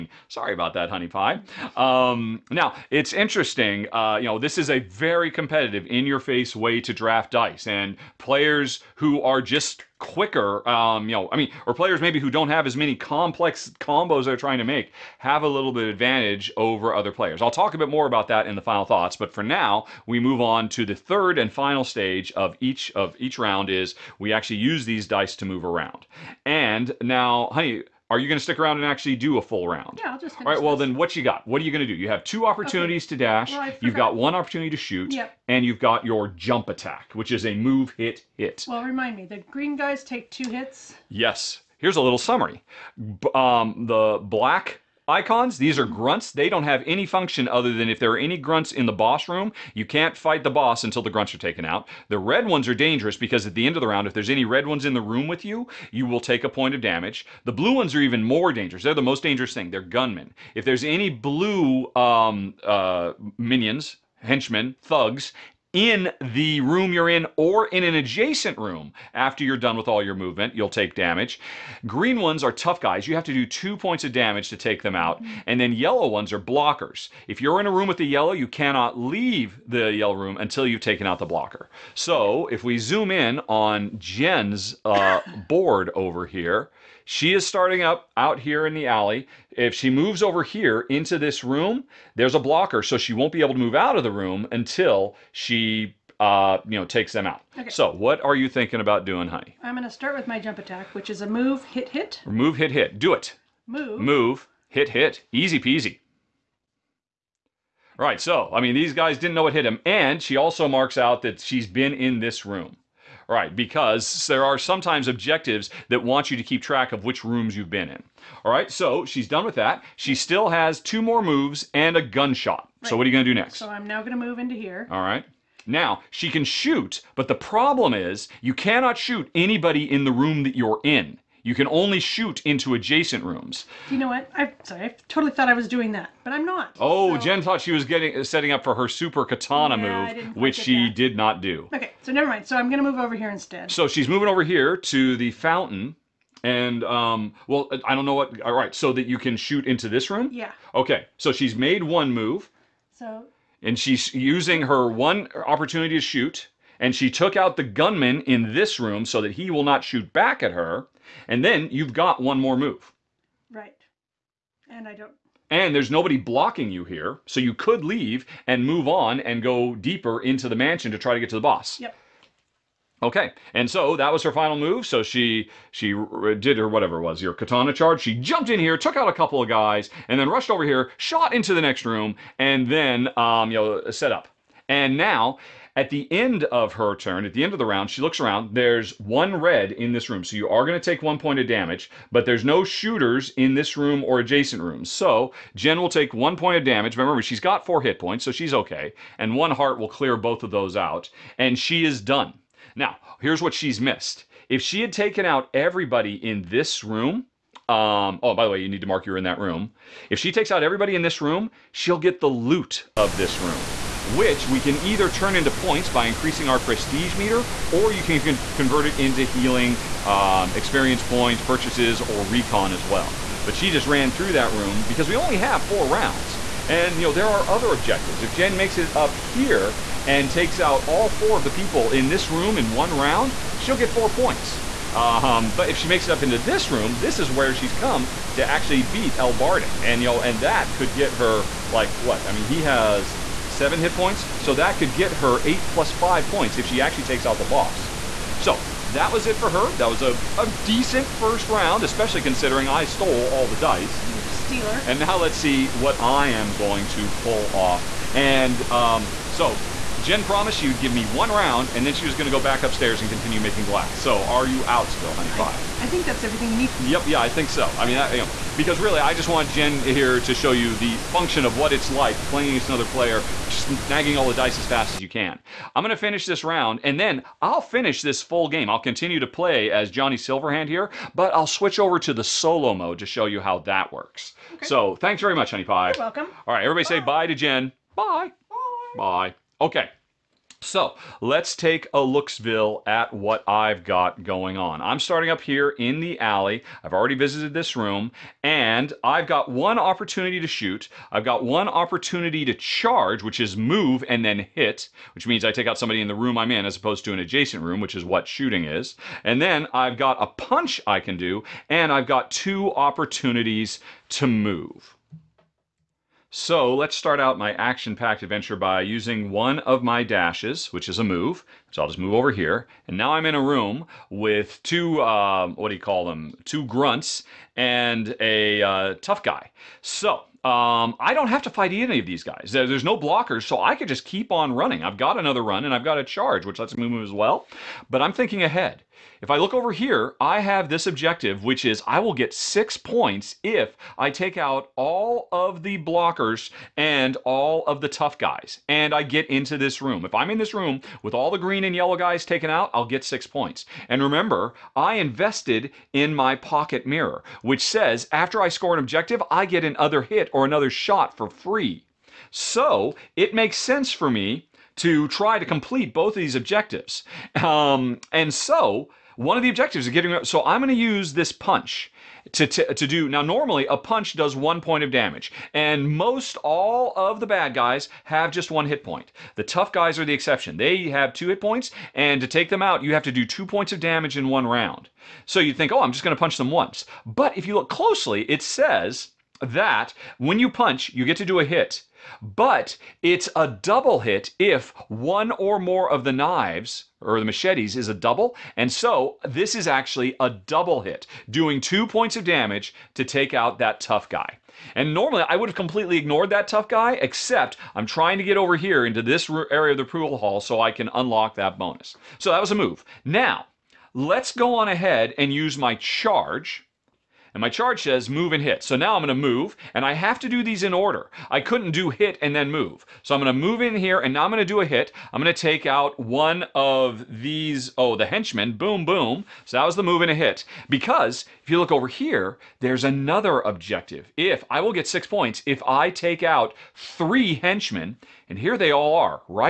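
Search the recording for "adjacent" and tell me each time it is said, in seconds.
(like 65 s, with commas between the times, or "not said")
67 s, 132 s, 194 s, 307 s.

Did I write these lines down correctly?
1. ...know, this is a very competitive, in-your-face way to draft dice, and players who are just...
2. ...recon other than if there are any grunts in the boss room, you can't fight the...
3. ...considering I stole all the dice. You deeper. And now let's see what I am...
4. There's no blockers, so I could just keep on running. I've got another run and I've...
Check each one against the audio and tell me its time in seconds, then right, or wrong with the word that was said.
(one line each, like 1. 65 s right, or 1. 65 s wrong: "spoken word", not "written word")
1. 4 s right
2. 47 s wrong: "function", not "recon"
3. 252 s wrong: "stealer", not "deeper"
4. 332 s right.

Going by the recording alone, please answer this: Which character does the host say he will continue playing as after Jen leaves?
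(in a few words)
Johnny Silverhand.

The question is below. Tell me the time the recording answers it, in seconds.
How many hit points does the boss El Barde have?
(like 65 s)
242 s.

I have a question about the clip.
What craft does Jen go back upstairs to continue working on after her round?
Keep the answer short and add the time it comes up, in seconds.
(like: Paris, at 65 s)
Making glass, at 263 s.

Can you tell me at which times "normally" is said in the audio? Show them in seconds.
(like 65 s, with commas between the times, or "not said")
373 s, 404 s.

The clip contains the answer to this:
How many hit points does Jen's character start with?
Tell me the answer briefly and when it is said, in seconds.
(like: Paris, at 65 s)
4, at 197 s.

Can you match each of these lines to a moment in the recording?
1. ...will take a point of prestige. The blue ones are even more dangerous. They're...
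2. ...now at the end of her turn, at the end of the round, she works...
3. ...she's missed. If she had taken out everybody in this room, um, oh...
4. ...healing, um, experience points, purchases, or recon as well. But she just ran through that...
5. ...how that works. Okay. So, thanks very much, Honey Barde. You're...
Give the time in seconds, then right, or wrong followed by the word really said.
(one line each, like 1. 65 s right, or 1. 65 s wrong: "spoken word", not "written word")
1. 56 s wrong: "damage", not "prestige"
2. 184 s wrong: "looks", not "works"
3. 203 s right
4. 219 s right
5. 283 s wrong: "Pie", not "Barde".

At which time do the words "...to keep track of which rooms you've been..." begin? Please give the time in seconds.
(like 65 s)
116 s.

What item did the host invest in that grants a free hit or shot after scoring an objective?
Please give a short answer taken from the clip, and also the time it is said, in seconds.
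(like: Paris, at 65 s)
Pocket mirror, at 356 s.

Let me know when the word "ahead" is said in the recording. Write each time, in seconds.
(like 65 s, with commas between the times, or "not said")
338 s, 414 s.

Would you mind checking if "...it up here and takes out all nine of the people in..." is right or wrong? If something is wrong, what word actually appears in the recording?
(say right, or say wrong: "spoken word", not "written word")
wrong: "four", not "nine".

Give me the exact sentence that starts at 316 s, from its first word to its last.
So let's start out my action-packed adventure by using one of my dashes, which is a move.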